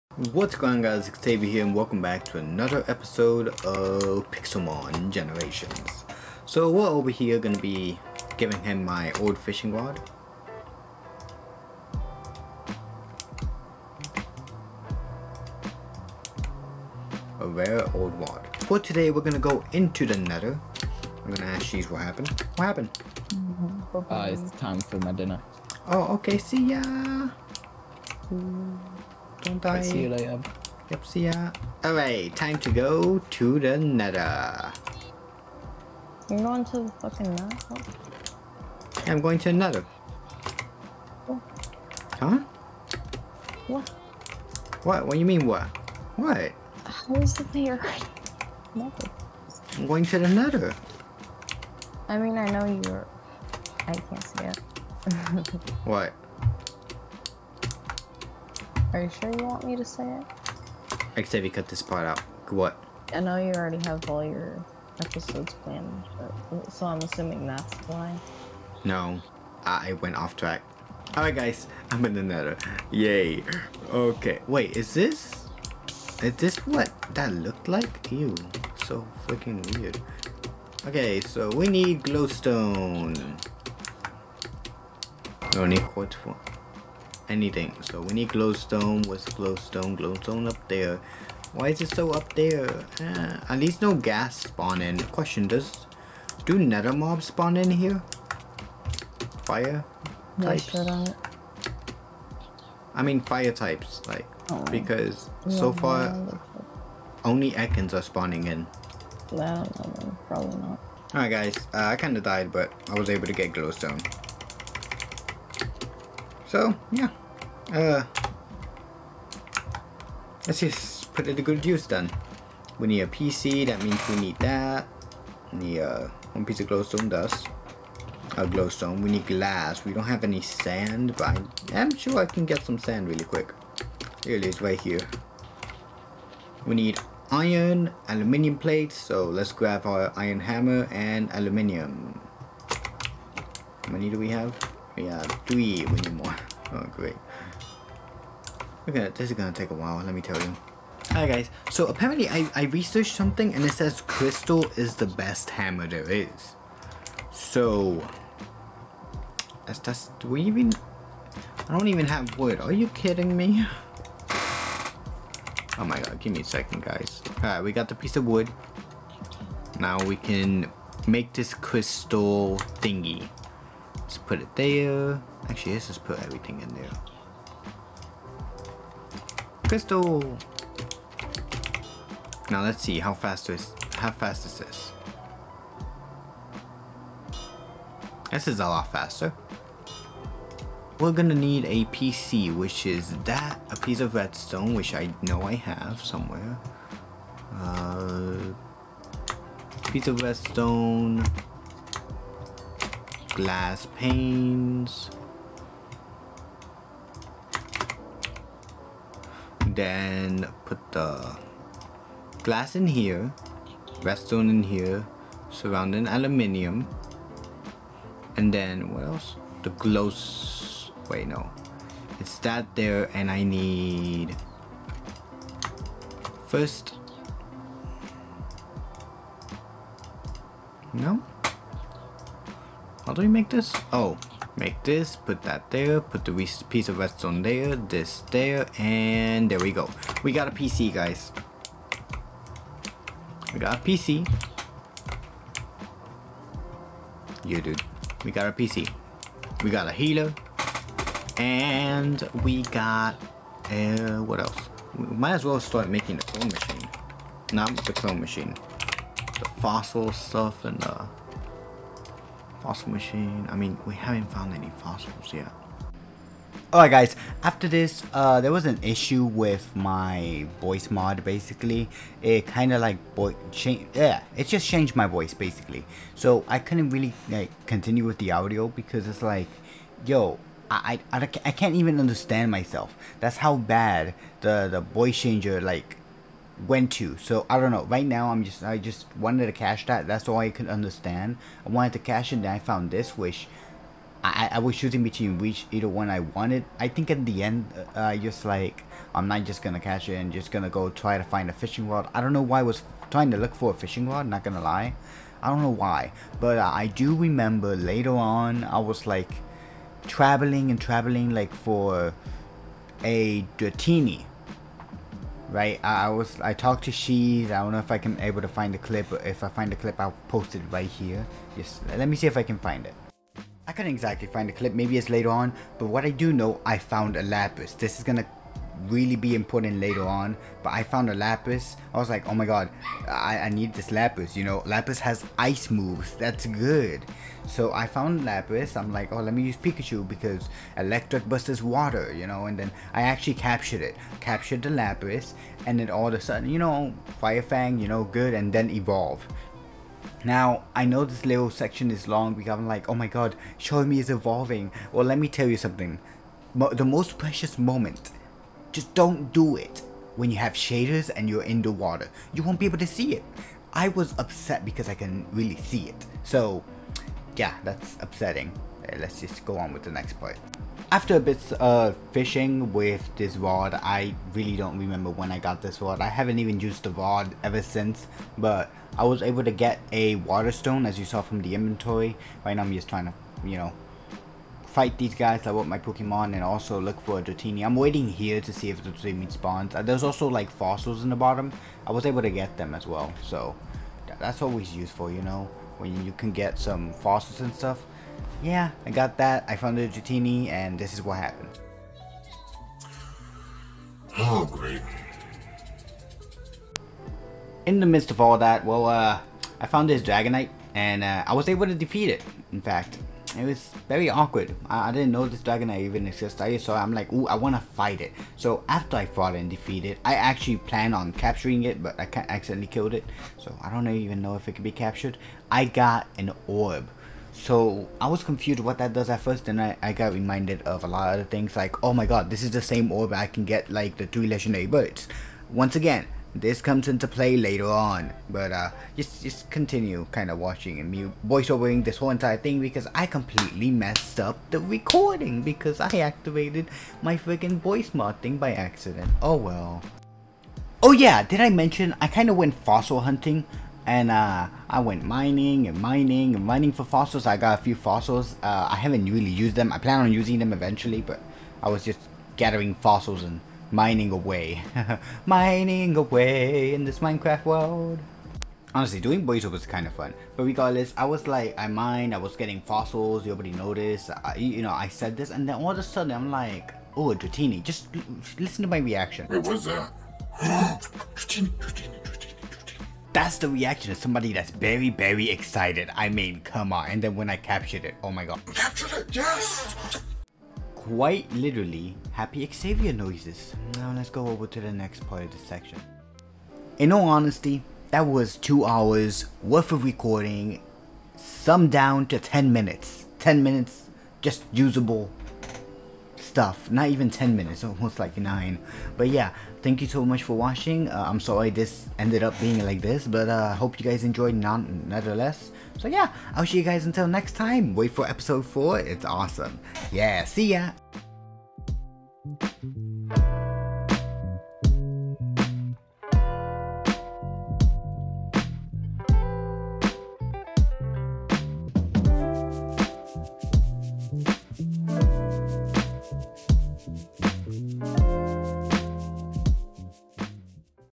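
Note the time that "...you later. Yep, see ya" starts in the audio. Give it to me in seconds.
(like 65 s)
30 s.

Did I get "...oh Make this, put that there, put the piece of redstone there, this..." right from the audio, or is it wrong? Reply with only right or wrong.
right.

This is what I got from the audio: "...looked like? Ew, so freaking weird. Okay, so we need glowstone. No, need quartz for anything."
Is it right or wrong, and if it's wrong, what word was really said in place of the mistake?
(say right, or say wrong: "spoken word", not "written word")
right.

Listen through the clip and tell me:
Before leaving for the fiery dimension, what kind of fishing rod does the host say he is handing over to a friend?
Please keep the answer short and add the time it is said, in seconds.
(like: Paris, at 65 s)
Old rod, at 17 s.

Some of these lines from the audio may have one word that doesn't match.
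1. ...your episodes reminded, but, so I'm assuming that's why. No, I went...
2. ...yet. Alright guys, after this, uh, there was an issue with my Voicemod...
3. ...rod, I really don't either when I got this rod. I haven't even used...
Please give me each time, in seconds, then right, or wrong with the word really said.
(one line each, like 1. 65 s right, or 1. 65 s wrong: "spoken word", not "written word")
1. 64 s wrong: "planned", not "reminded"
2. 265 s right
3. 373 s wrong: "remember", not "either".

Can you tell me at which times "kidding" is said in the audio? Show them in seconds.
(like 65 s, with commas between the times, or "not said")
162 s.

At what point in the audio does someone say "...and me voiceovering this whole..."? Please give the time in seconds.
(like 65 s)
440 s.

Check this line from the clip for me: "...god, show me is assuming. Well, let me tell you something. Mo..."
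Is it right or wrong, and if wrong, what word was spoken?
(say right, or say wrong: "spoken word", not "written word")
wrong: "evolving", not "assuming".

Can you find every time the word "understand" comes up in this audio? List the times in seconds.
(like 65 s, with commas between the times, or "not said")
281 s, 290 s.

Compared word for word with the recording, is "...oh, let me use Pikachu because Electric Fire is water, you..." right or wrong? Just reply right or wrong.
wrong.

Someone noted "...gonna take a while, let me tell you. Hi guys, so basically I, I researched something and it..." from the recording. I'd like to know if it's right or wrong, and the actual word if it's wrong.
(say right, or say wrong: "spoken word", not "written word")
wrong: "apparently", not "basically".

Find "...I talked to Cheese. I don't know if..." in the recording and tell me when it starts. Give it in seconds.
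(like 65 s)
316 s.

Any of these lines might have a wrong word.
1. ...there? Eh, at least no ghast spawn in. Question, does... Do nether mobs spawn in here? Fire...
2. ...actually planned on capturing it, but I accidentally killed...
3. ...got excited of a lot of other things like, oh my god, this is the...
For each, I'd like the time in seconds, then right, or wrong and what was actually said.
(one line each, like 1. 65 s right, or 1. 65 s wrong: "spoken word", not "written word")
1. 92 s right
2. 420 s right
3. 429 s wrong: "reminded", not "excited".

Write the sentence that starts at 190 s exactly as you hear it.
We're gonna need a PC, which is that, a piece of redstone, which I know I have somewhere.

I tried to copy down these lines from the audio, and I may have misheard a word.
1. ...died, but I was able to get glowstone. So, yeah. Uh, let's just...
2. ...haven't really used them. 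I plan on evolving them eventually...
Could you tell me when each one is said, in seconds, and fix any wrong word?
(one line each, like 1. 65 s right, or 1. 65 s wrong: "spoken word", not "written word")
1. 112 s right
2. 458 s wrong: "using", not "evolving".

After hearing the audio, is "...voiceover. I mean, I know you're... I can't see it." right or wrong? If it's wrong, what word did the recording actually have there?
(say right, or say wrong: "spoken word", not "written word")
wrong: "nether", not "voiceover".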